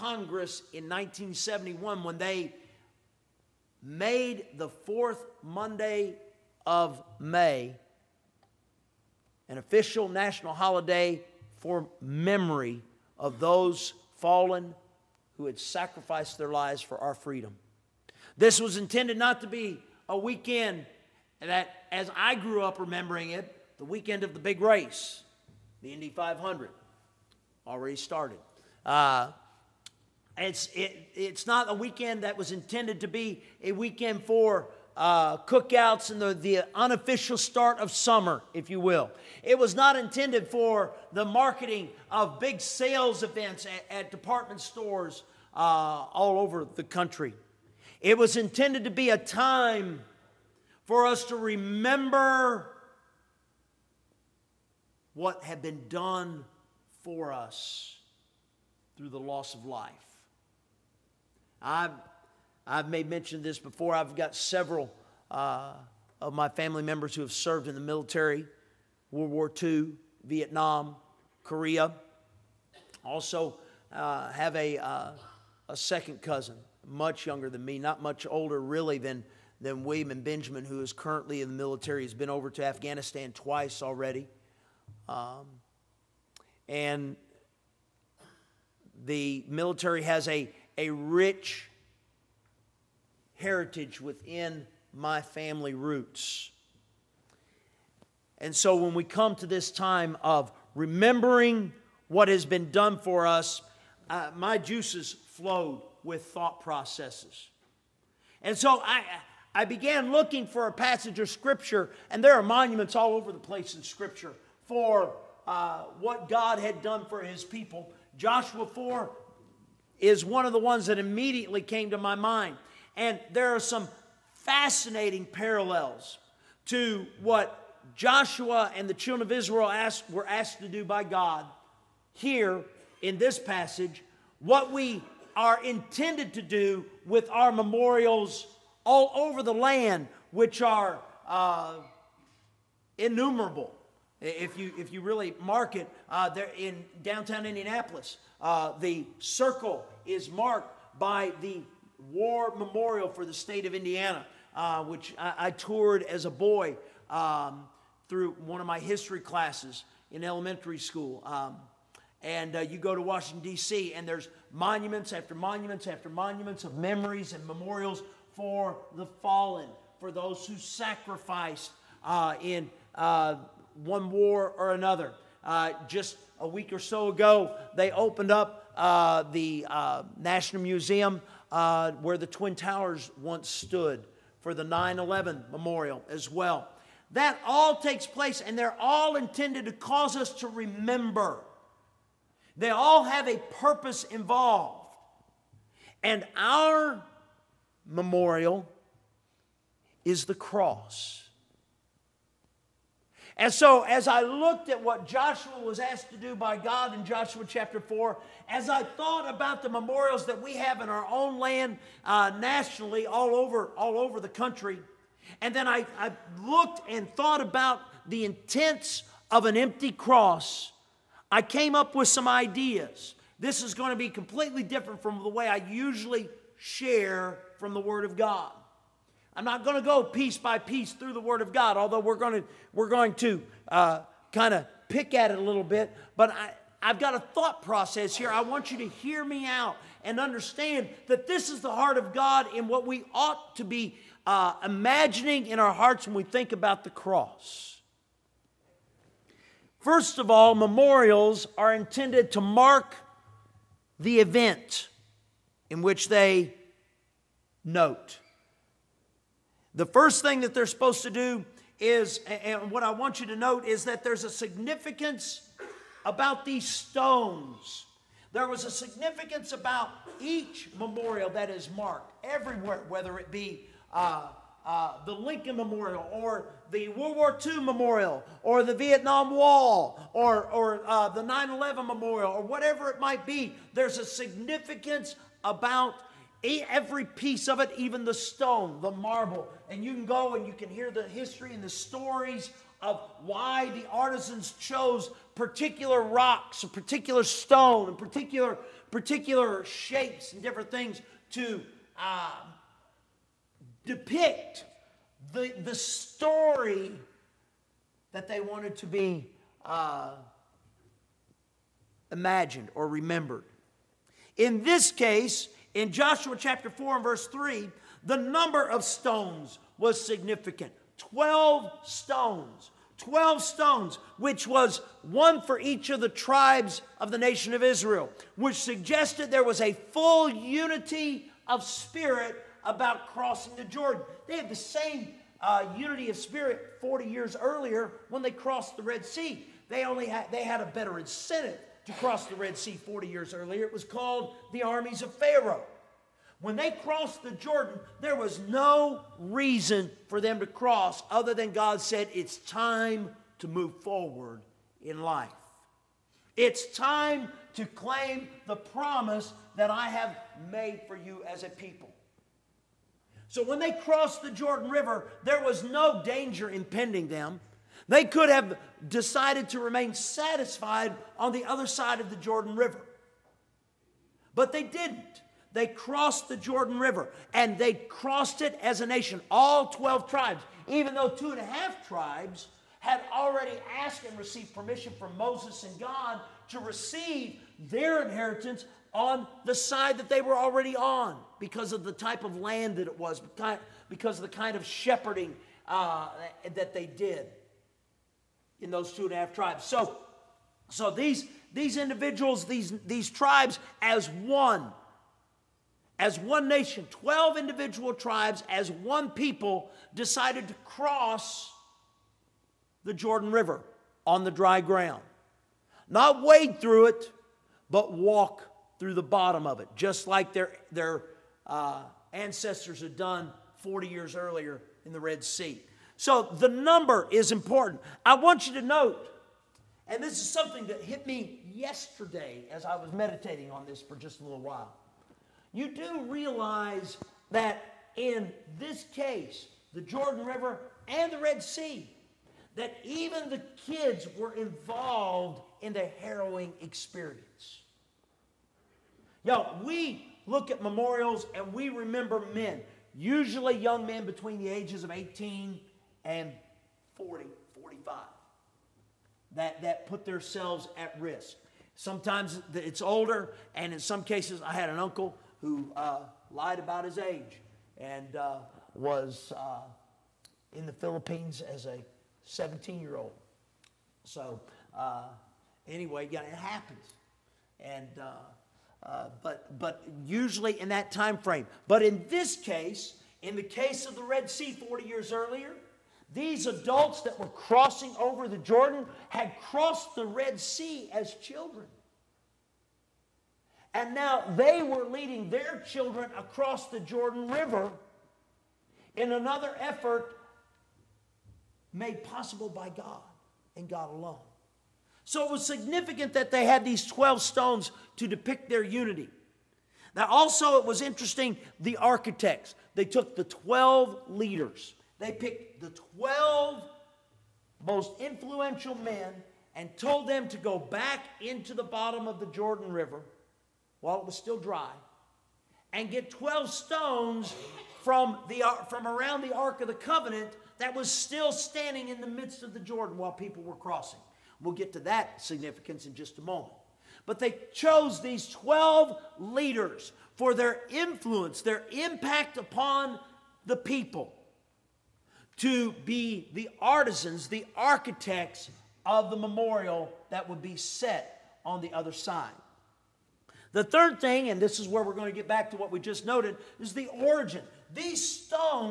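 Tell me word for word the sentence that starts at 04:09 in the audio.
First of all, memorials are intended to mark the event in which they note.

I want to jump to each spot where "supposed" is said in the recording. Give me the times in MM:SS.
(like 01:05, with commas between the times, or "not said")
04:20.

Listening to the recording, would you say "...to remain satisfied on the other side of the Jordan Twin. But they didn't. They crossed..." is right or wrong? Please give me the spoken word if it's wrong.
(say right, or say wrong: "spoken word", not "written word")
wrong: "River", not "Twin".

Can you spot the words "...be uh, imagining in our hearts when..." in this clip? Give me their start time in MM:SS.
04:03.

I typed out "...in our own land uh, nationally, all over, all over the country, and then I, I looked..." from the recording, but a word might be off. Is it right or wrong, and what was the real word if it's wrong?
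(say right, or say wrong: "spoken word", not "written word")
right.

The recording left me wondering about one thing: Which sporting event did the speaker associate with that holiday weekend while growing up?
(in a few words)
Indy 500.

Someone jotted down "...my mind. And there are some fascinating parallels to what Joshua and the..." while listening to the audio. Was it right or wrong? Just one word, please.
right.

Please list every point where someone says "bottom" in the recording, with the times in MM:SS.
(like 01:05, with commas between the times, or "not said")
06:59, 08:41.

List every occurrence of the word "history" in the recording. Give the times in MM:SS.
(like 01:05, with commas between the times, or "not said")
02:38, 04:51.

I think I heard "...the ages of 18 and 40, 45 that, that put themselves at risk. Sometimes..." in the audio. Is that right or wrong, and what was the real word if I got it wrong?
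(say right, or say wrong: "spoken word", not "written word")
right.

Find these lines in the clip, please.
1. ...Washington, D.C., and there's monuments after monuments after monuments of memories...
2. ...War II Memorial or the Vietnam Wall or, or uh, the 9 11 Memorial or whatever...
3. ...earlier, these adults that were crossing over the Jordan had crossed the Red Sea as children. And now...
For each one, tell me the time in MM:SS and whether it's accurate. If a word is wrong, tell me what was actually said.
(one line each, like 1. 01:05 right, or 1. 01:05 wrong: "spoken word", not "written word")
1. 02:43 right
2. 04:37 right
3. 08:05 right.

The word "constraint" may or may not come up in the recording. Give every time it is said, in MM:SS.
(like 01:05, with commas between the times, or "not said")
not said.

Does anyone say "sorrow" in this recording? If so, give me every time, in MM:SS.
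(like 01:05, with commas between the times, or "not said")
not said.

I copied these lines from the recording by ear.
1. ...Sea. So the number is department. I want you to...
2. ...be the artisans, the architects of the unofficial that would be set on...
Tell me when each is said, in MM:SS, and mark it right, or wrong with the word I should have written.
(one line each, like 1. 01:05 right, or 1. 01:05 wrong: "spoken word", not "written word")
1. 07:05 wrong: "important", not "department"
2. 09:05 wrong: "memorial", not "unofficial".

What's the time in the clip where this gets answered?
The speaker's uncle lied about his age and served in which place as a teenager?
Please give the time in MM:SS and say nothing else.
07:50.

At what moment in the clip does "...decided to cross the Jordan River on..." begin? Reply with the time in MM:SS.
06:49.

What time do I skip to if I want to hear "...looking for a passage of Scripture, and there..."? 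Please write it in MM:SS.
01:50.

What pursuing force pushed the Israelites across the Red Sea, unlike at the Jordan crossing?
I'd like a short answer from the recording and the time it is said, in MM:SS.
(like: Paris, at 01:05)
Armies of Pharaoh, at 05:44.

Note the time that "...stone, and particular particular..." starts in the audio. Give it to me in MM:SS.
04:57.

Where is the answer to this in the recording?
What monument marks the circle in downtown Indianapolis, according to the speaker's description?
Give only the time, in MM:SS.
02:32.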